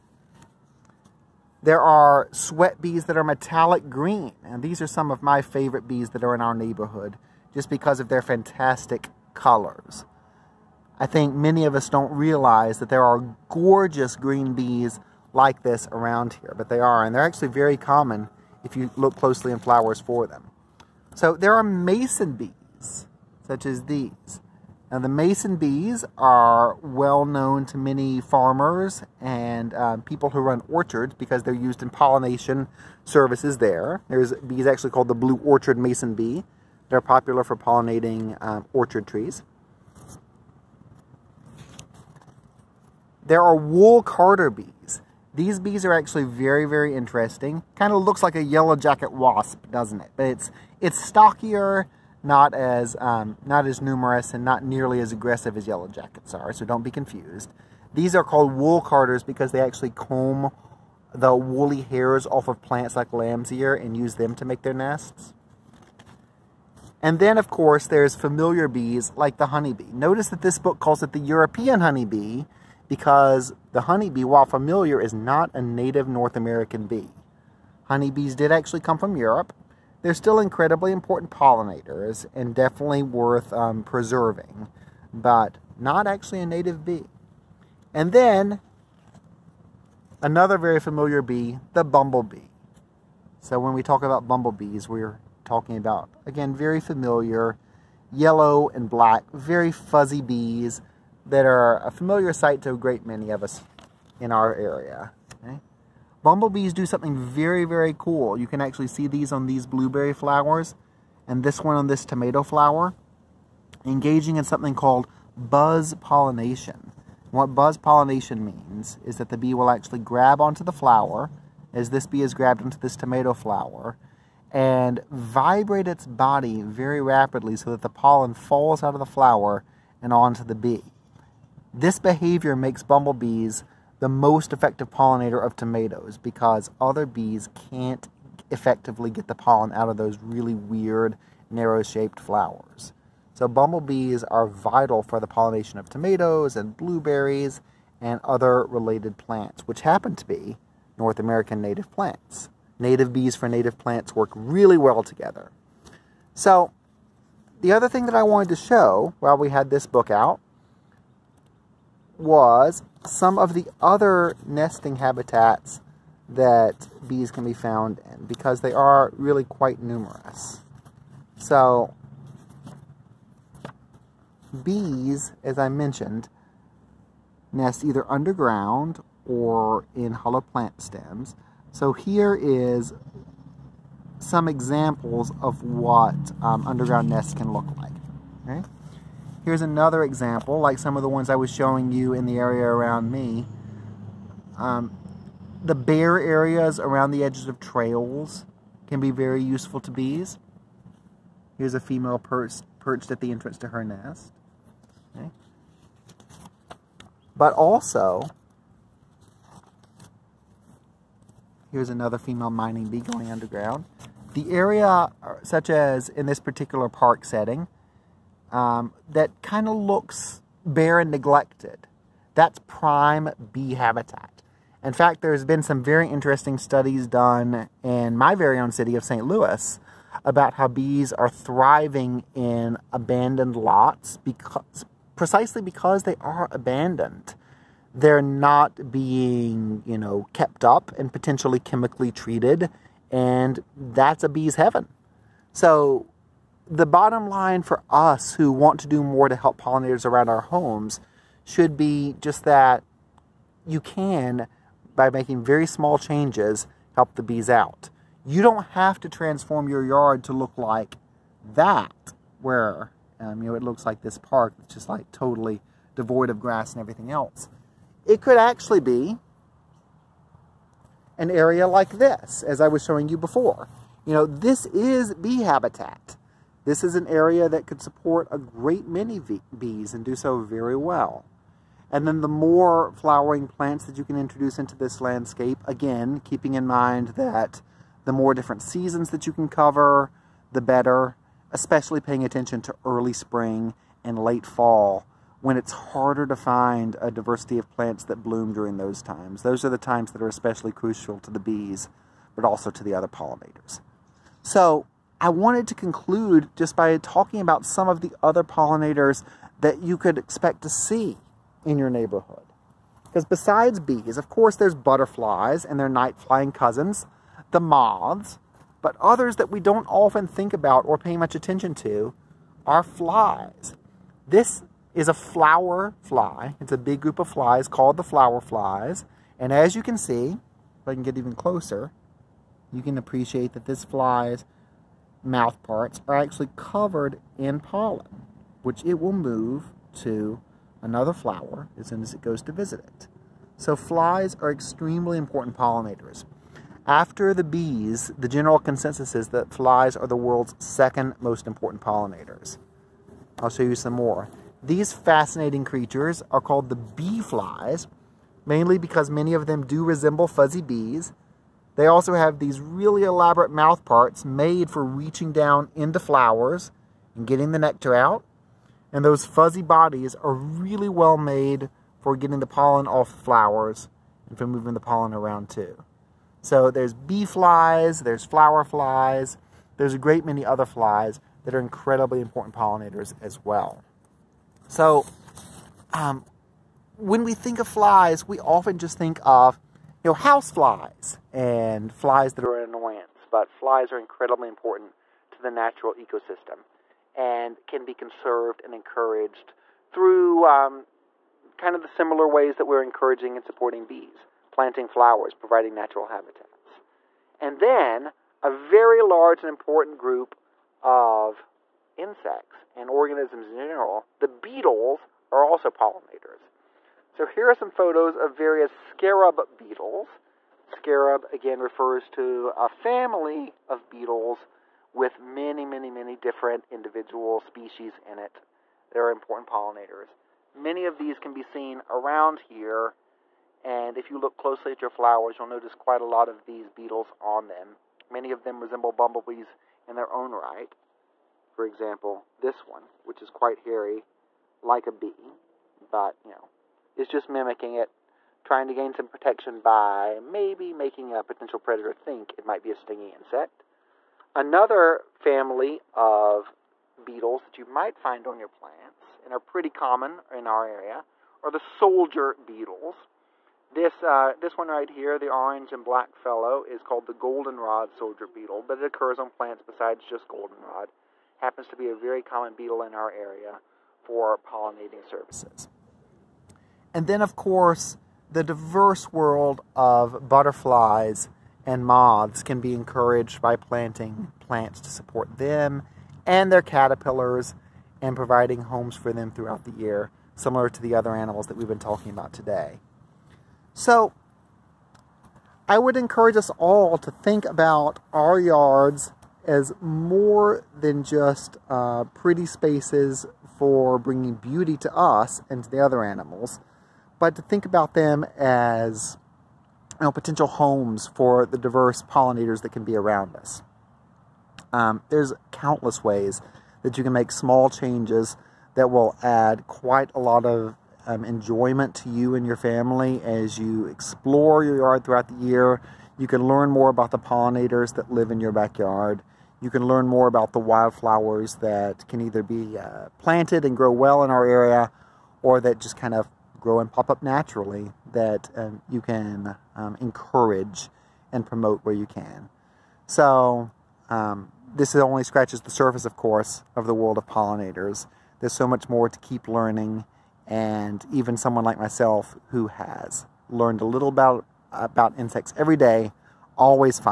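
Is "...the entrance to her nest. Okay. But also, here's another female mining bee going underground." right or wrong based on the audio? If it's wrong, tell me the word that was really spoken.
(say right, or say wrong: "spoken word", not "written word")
right.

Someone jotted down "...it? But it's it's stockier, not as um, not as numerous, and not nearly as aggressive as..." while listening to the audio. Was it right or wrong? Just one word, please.
right.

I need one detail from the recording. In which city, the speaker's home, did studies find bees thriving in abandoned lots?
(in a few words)
St. Louis.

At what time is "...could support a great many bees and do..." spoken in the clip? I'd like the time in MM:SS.
04:37.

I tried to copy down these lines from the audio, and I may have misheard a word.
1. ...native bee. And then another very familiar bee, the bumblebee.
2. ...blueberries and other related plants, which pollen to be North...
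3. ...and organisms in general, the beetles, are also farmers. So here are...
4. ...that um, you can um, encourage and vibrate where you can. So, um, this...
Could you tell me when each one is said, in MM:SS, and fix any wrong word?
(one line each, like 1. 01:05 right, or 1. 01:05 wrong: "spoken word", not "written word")
1. 01:26 right
2. 02:26 wrong: "happen", not "pollen"
3. 06:52 wrong: "pollinators", not "farmers"
4. 08:58 wrong: "promote", not "vibrate".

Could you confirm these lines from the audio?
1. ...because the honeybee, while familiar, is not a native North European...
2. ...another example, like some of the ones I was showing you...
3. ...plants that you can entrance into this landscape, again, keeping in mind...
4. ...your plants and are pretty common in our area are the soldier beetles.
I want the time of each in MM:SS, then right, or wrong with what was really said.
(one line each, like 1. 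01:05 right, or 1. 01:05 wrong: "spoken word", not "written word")
1. 01:12 wrong: "American", not "European"
2. 03:09 right
3. 04:43 wrong: "introduce", not "entrance"
4. 07:38 right.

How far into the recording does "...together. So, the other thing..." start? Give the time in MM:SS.
02:35.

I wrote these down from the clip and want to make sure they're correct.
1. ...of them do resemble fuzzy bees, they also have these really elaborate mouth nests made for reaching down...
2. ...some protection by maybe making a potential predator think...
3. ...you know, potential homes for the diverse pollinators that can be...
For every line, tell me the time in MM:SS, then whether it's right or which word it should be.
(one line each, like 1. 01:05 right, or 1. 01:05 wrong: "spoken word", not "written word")
1. 05:59 wrong: "parts", not "nests"
2. 07:28 right
3. 08:29 right.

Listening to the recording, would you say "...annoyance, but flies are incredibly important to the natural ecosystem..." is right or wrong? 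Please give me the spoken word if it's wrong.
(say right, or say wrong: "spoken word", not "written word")
right.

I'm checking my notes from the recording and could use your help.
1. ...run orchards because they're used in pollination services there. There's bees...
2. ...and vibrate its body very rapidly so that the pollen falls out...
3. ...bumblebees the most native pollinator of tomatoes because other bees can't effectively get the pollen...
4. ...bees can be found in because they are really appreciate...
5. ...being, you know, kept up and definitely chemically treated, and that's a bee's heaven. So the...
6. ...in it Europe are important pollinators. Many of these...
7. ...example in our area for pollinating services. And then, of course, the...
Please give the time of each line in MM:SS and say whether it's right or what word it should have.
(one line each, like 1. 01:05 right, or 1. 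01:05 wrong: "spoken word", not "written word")
1. 00:30 right
2. 02:04 right
3. 02:12 wrong: "effective", not "native"
4. 02:47 wrong: "quite", not "appreciate"
5. 03:58 wrong: "potentially", not "definitely"
6. 07:08 wrong: "They", not "Europe"
7. 07:52 wrong: "beetle", not "example".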